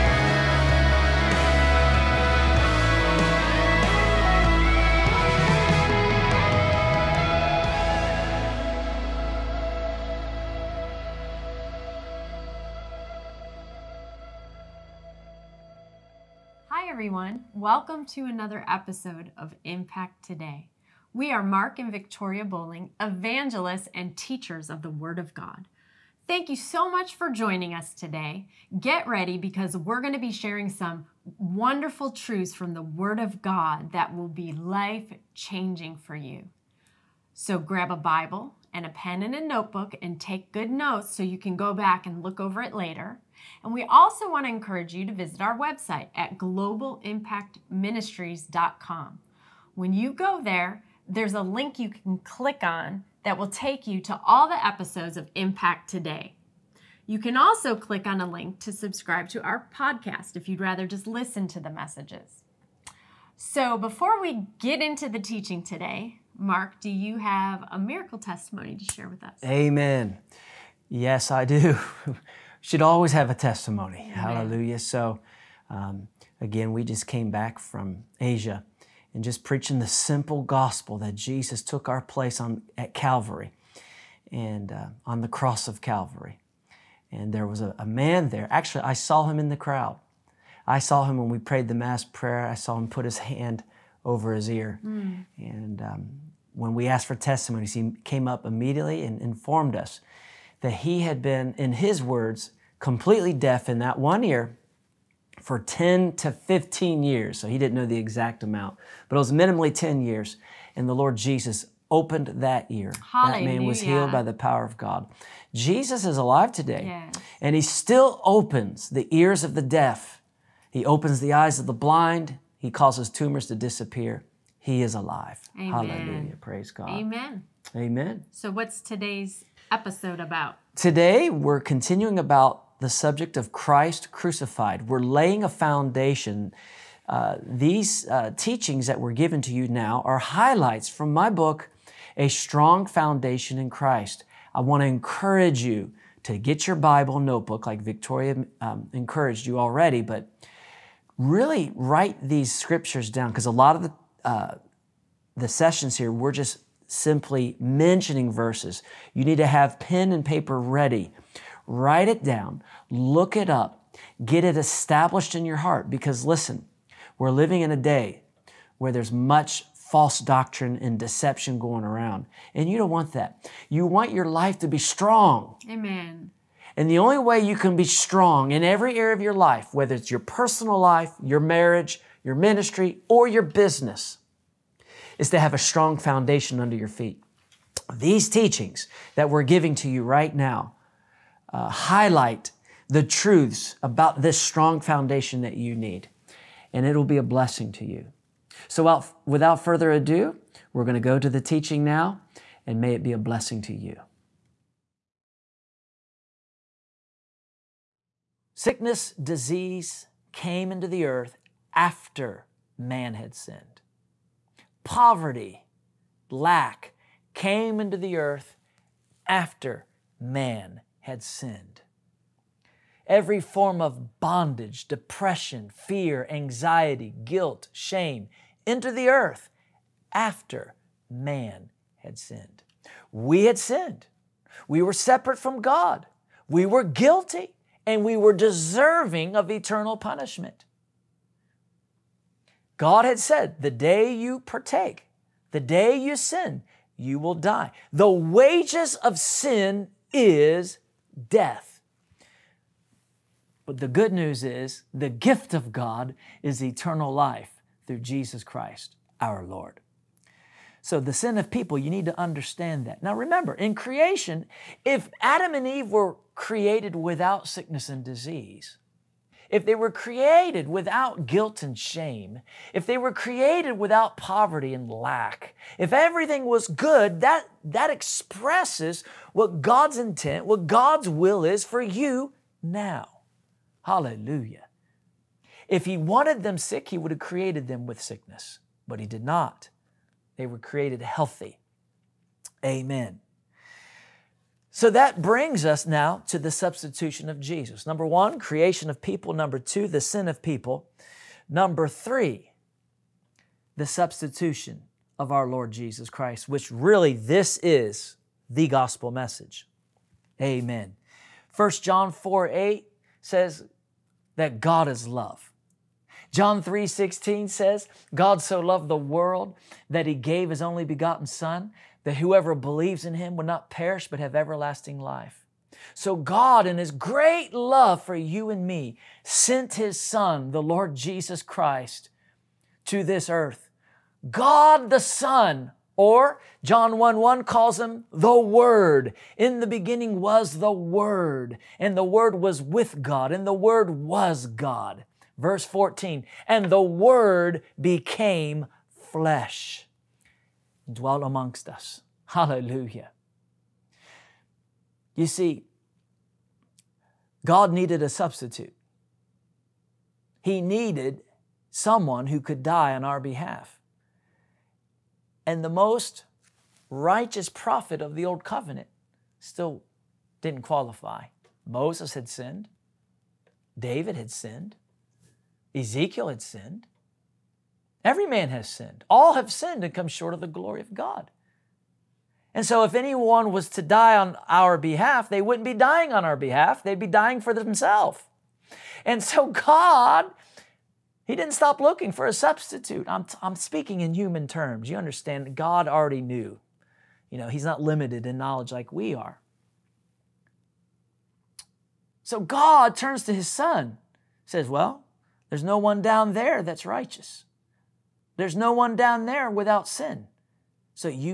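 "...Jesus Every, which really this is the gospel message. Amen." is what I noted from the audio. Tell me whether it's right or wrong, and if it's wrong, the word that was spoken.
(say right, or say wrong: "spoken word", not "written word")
wrong: "Christ", not "Every".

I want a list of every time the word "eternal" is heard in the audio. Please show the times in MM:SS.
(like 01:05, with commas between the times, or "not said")
03:59, 04:16.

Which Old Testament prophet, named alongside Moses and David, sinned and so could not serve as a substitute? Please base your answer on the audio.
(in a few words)
Ezekiel.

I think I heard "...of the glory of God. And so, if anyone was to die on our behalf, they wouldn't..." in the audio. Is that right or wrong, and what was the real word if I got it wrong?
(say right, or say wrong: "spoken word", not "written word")
right.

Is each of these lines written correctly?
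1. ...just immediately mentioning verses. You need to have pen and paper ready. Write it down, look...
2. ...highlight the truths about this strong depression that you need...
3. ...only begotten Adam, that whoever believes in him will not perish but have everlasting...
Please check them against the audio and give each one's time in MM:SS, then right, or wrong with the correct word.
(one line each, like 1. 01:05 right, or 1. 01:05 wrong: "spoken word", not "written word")
1. 02:36 wrong: "simply", not "immediately"
2. 03:11 wrong: "foundation", not "depression"
3. 05:20 wrong: "Son", not "Adam".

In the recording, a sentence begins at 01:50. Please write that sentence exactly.
And the Lord Jesus opened that ear.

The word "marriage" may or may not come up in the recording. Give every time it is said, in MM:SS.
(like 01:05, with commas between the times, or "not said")
03:01.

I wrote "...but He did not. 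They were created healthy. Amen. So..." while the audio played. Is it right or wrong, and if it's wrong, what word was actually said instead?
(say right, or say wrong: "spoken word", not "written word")
right.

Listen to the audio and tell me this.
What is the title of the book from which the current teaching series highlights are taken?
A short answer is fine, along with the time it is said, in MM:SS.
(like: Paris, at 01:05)
A Strong Foundation in Christ, at 02:22.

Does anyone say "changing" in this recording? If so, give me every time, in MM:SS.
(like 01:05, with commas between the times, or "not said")
00:35.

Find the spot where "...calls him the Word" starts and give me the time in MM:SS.
05:37.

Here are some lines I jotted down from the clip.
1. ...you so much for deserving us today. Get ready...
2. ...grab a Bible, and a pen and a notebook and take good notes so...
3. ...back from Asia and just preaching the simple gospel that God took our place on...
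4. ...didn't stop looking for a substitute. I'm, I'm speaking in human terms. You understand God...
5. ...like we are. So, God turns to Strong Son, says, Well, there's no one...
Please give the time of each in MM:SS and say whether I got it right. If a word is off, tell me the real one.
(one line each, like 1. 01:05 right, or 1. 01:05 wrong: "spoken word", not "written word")
1. 00:26 wrong: "joining", not "deserving"
2. 00:37 right
3. 01:17 wrong: "Jesus", not "God"
4. 06:31 right
5. 06:38 wrong: "His", not "Strong".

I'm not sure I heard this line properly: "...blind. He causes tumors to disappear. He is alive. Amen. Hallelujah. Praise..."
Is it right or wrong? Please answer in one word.
right.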